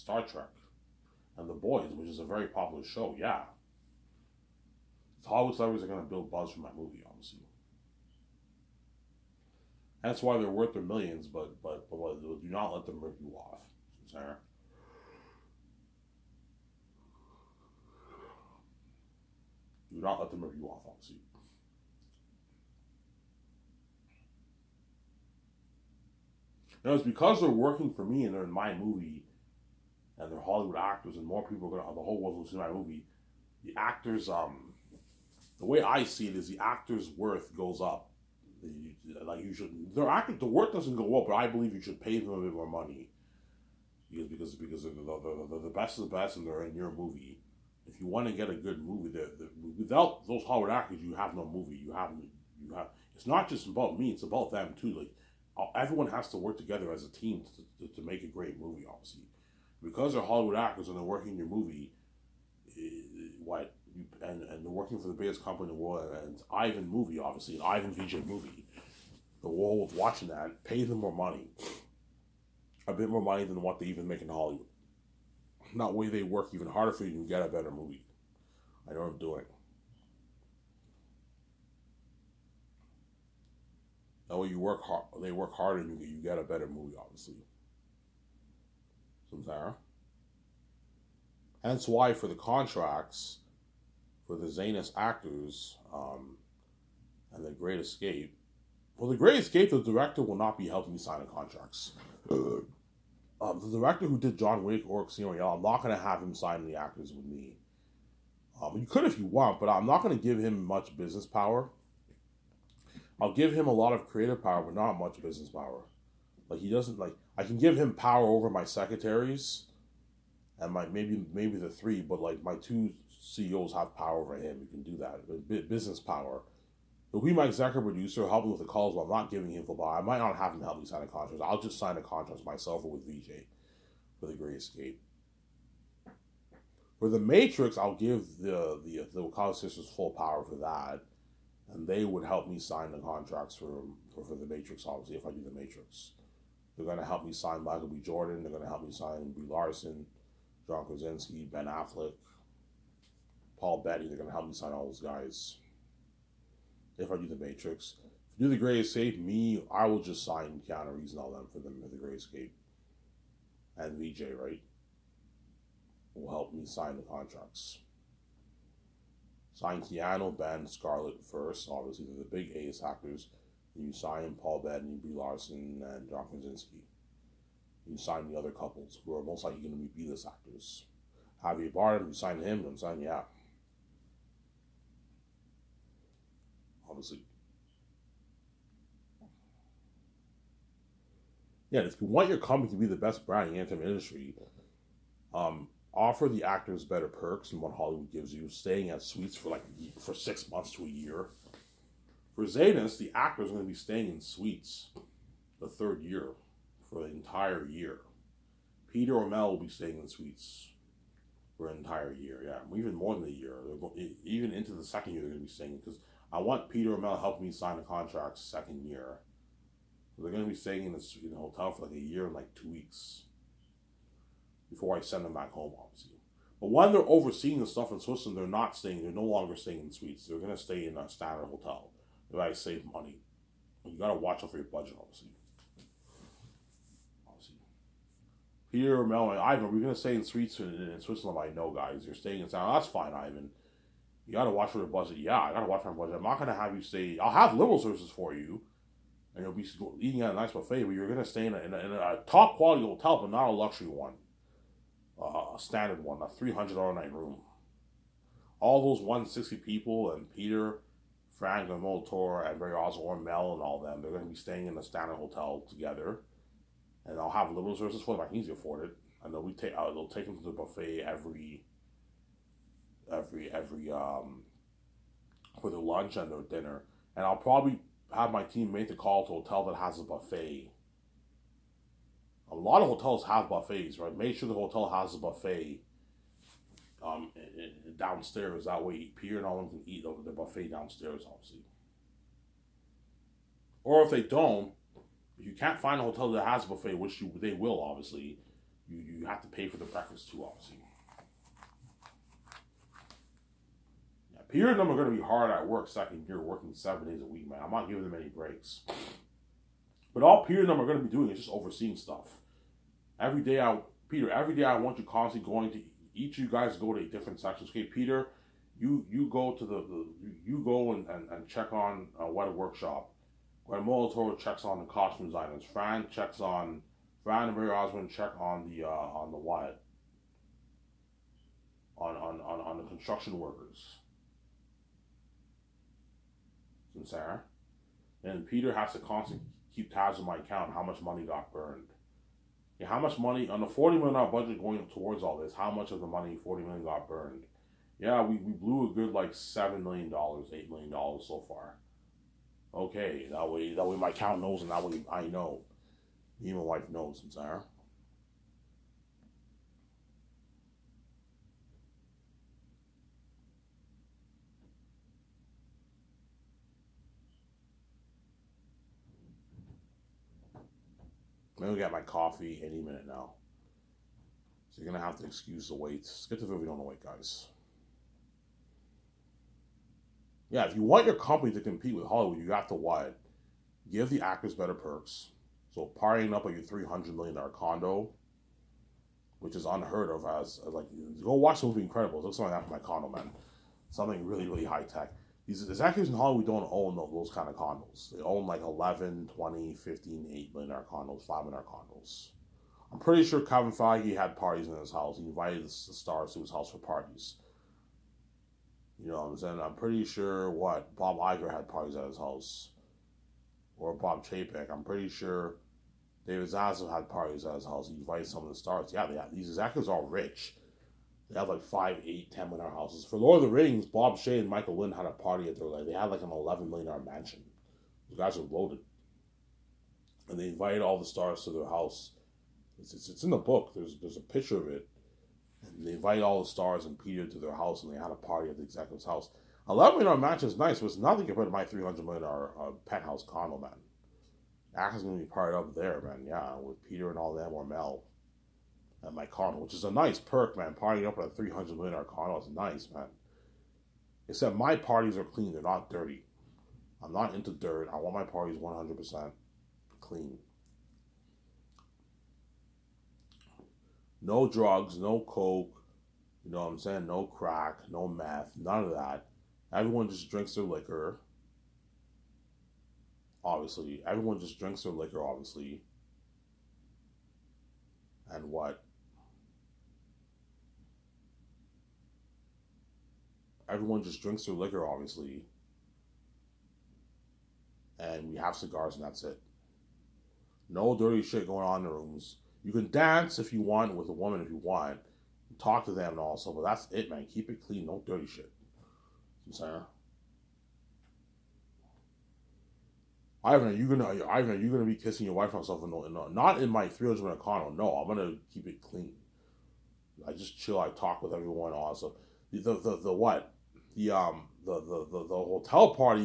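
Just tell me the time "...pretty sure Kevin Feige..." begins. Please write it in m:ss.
6:42.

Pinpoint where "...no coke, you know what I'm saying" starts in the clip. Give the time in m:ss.
7:44.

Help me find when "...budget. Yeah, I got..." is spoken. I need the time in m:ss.
4:04.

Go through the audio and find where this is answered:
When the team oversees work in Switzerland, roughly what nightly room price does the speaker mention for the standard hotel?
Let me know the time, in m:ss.
4:16.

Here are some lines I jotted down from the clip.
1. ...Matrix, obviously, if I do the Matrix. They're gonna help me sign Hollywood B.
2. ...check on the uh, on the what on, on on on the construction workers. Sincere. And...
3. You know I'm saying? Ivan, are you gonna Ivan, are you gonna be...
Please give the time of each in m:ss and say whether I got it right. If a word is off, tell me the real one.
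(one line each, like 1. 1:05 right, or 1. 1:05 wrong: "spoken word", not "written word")
1. 2:24 wrong: "Michael", not "Hollywood"
2. 5:28 right
3. 8:19 right.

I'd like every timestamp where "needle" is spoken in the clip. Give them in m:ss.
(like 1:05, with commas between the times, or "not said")
not said.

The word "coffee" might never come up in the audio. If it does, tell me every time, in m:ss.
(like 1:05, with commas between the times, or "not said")
6:12.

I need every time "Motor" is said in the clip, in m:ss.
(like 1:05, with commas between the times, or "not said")
4:21.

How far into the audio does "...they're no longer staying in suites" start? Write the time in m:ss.
3:49.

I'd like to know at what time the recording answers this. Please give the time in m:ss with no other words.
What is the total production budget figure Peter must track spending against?
5:43.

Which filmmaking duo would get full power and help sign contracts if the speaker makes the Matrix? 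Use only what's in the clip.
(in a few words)
Wachowski sisters.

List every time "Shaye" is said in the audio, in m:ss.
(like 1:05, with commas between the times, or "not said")
7:04.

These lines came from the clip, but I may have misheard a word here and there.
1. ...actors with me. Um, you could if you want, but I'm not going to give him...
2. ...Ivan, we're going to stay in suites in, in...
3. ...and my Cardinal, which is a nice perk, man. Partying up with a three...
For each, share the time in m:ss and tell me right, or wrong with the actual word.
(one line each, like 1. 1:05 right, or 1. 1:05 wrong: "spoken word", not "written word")
1. 1:46 right
2. 3:59 right
3. 7:29 right.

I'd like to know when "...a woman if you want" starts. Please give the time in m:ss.
8:14.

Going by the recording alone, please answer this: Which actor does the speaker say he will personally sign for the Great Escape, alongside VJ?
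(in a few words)
Keanu Reeves.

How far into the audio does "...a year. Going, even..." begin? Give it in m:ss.
3:33.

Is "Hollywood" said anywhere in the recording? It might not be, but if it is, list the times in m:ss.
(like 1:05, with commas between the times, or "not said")
0:05, 0:30, 0:50, 1:00, 1:14, 3:17, 6:22, 6:36.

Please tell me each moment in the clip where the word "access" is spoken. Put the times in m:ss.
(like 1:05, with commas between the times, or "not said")
not said.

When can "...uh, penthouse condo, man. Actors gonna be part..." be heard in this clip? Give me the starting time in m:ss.
7:22.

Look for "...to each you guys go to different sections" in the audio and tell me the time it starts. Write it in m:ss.
5:15.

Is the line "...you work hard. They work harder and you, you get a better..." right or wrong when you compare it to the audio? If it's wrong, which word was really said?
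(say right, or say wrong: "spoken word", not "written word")
right.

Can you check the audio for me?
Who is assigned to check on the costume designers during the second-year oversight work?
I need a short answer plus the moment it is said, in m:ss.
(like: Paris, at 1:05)
Gwen Toro, at 5:23.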